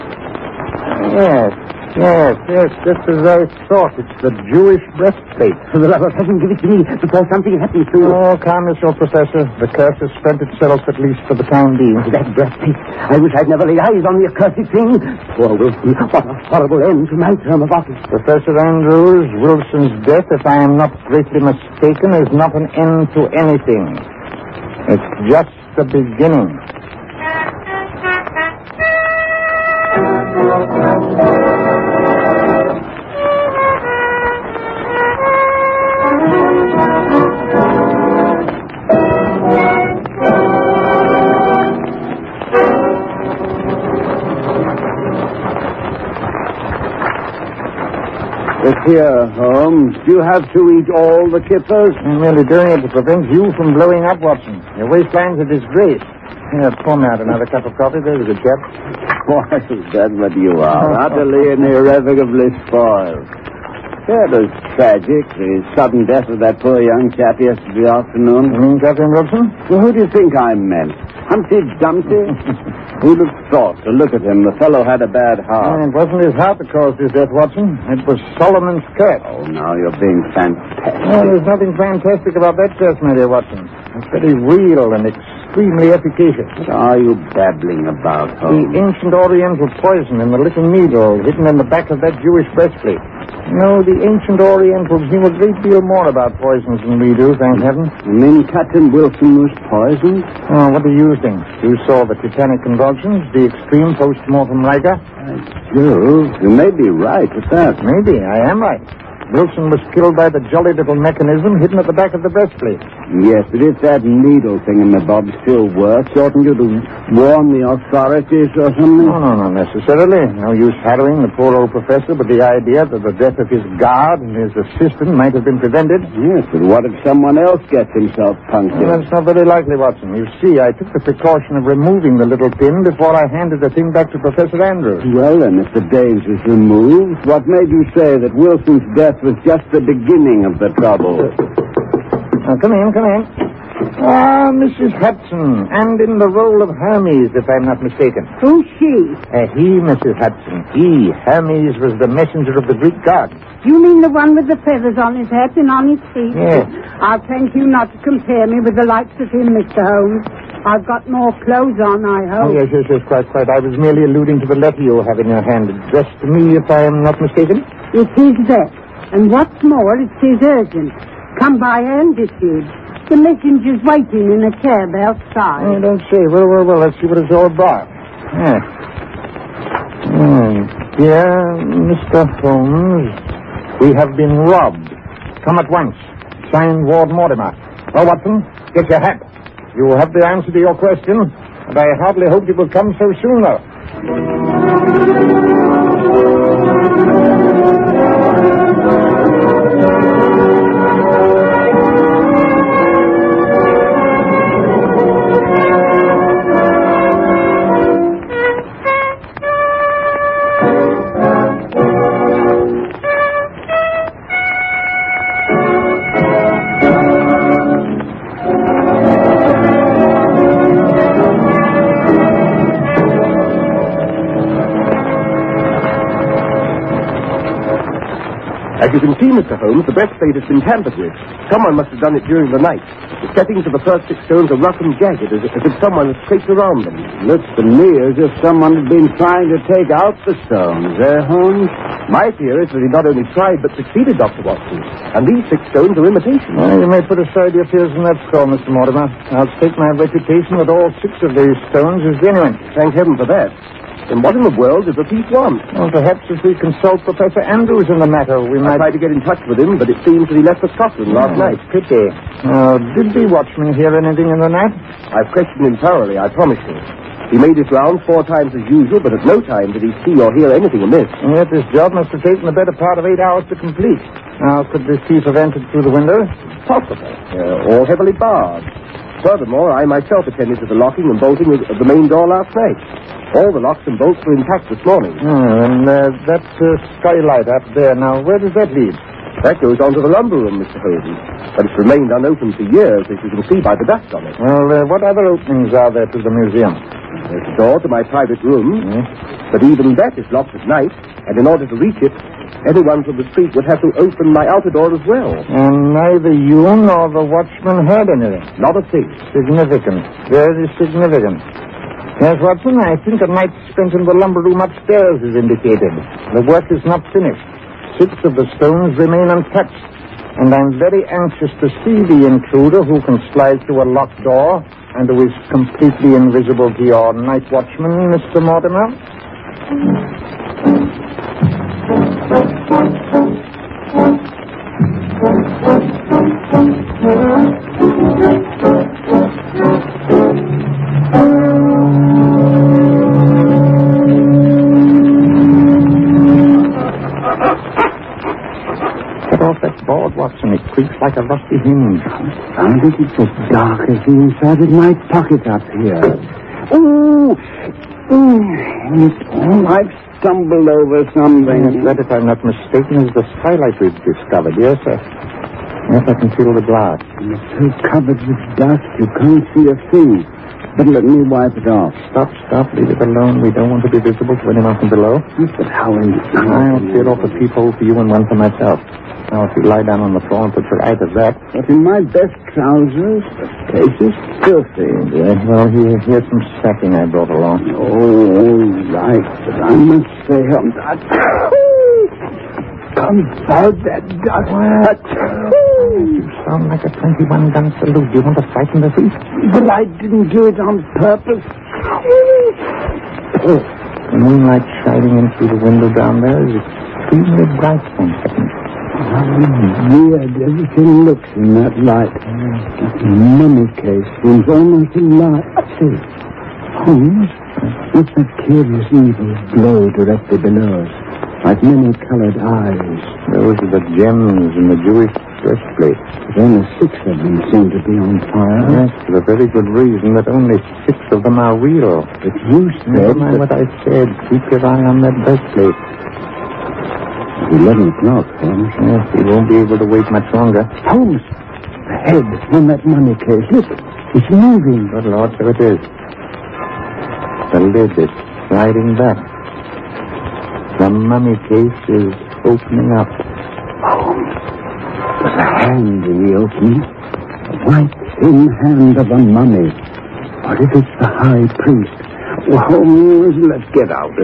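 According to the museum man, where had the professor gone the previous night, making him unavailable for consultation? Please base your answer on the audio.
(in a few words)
Scotland.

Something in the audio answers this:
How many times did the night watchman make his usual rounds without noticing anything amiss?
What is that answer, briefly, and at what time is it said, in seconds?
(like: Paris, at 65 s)
4, at 268 s.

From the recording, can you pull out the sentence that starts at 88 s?
The ancient Oriental poison in the little needle hidden in the back of that Jewish breastplate.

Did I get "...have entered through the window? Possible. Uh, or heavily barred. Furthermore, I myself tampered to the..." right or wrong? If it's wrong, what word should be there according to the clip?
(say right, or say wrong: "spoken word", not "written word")
wrong: "attended", not "tampered".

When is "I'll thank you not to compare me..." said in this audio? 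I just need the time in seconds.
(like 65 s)
156 s.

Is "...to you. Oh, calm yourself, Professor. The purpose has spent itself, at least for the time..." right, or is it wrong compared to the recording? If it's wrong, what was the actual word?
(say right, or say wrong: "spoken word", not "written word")
wrong: "curse", not "purpose".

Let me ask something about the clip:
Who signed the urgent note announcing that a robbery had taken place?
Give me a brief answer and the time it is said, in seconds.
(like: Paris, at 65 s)
Ward Mortimer, at 186 s.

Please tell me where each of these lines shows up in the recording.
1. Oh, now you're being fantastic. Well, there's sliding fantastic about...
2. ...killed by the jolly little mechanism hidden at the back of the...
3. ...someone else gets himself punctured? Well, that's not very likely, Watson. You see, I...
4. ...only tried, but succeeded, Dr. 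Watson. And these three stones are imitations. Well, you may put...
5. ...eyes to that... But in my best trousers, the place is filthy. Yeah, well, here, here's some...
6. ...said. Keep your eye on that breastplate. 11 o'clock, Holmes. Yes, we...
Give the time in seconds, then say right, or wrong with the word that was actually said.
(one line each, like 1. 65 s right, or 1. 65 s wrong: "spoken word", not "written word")
1. 79 s wrong: "nothing", not "sliding"
2. 109 s right
3. 127 s right
4. 243 s wrong: "six", not "three"
5. 380 s right
6. 433 s right.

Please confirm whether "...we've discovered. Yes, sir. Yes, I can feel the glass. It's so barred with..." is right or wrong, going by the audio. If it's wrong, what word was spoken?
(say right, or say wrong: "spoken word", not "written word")
wrong: "covered", not "barred".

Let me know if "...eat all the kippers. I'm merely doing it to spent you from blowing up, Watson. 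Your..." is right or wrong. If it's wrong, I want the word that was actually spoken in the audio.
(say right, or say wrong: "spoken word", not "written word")
wrong: "prevent", not "spent".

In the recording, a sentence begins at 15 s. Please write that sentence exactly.
Poor Wilson, what a horrible end to my term of office.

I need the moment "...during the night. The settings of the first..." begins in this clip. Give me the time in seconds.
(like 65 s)
232 s.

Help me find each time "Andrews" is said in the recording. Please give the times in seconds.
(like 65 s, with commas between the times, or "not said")
18 s, 134 s, 257 s.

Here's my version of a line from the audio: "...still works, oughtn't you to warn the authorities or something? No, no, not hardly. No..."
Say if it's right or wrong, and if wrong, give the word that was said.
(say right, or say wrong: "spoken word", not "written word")
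wrong: "necessarily", not "hardly".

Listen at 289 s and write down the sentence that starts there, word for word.
That goes on to the lumber room, Mr.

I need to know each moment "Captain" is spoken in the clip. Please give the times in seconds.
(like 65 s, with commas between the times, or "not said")
68 s, 98 s.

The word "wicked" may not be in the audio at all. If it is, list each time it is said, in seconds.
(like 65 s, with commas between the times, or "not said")
not said.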